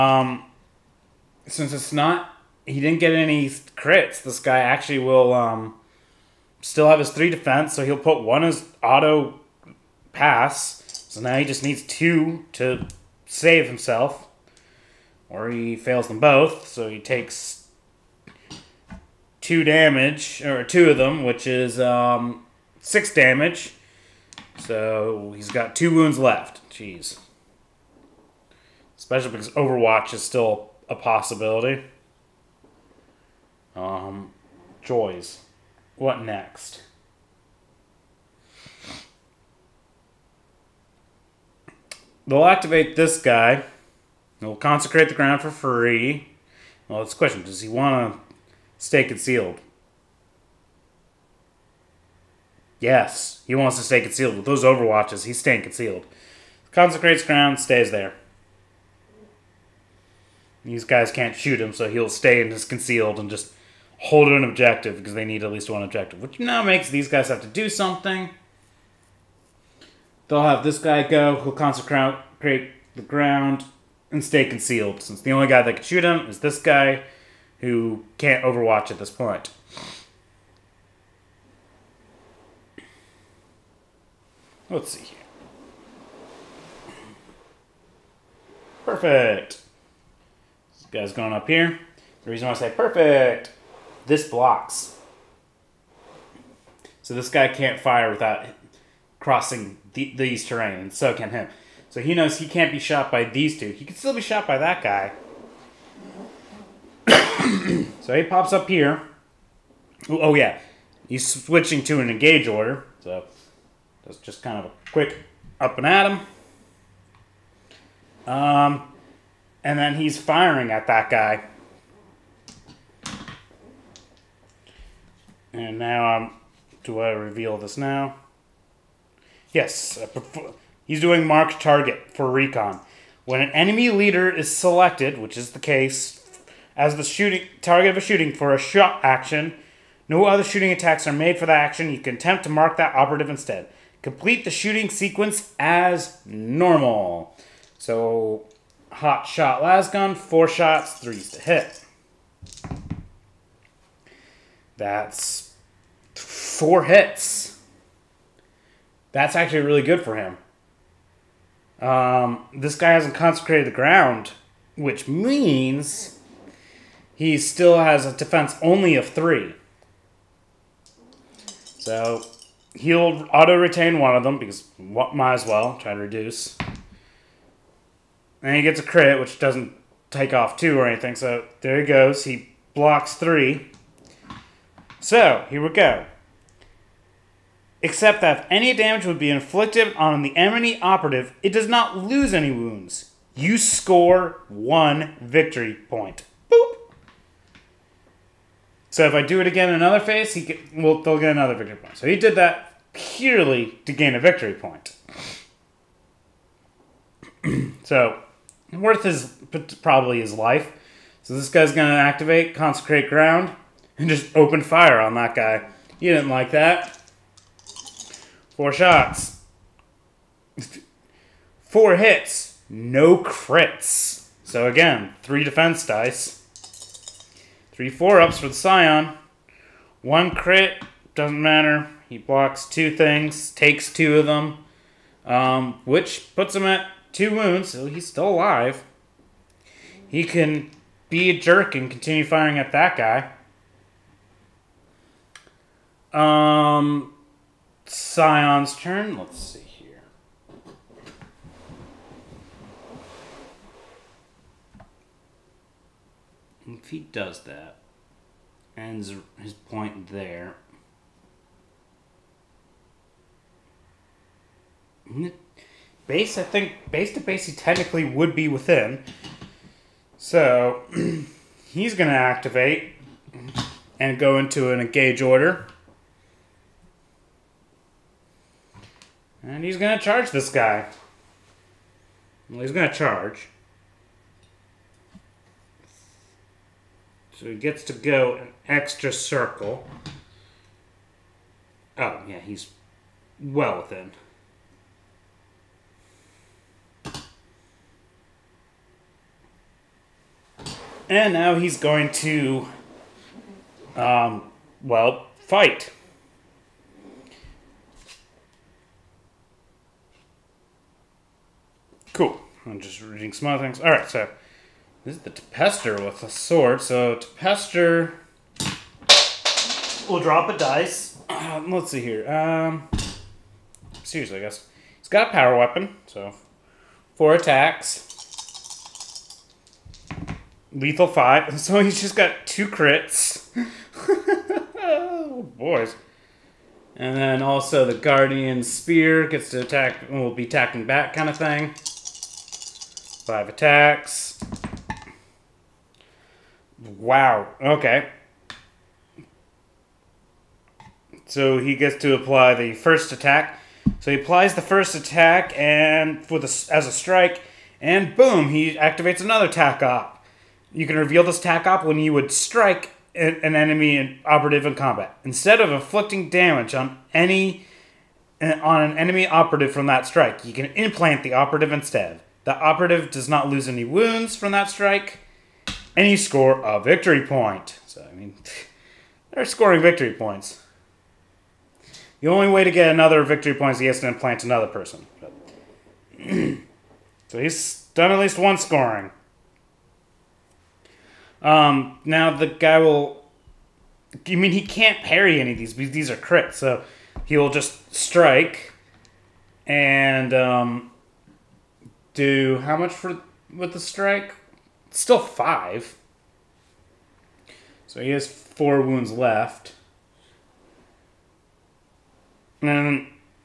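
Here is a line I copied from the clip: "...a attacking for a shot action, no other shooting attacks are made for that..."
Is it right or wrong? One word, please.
wrong.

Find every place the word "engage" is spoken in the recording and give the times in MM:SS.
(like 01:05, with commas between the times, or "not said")
01:52, 04:34.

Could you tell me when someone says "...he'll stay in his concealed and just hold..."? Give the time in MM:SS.
01:01.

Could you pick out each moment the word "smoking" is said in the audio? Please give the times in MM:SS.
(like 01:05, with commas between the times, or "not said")
not said.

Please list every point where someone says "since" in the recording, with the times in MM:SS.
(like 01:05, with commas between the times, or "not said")
00:01, 01:15.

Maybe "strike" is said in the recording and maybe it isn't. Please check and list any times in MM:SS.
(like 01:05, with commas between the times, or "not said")
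05:56, 06:02, 06:10, 06:14, 06:37, 06:43.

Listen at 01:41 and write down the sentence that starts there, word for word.
So he knows he can't be shot by these two.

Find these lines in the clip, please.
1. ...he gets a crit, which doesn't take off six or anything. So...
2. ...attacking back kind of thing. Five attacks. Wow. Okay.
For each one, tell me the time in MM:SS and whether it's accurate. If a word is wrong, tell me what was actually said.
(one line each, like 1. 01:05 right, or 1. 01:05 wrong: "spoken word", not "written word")
1. 02:58 wrong: "two", not "six"
2. 05:40 right.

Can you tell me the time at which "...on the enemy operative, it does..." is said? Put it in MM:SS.
03:09.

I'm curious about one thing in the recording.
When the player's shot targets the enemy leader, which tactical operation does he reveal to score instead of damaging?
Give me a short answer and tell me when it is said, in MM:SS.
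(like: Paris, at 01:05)
Mark target, at 02:11.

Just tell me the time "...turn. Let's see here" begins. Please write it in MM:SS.
04:08.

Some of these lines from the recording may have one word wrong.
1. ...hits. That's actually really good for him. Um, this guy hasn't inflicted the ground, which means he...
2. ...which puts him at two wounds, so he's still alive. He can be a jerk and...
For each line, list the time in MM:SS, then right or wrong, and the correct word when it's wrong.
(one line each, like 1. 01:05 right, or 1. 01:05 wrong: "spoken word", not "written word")
1. 02:36 wrong: "consecrated", not "inflicted"
2. 03:55 right.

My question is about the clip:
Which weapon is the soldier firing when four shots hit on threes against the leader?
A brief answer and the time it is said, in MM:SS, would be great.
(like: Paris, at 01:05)
Hot shot lasgun, at 02:28.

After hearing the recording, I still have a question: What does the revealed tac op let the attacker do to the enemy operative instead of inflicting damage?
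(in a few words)
Implant the operative.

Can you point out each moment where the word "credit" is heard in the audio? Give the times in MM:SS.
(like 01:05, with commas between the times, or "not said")
not said.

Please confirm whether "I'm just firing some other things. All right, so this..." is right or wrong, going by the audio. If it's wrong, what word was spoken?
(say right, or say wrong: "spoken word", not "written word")
wrong: "reading", not "firing".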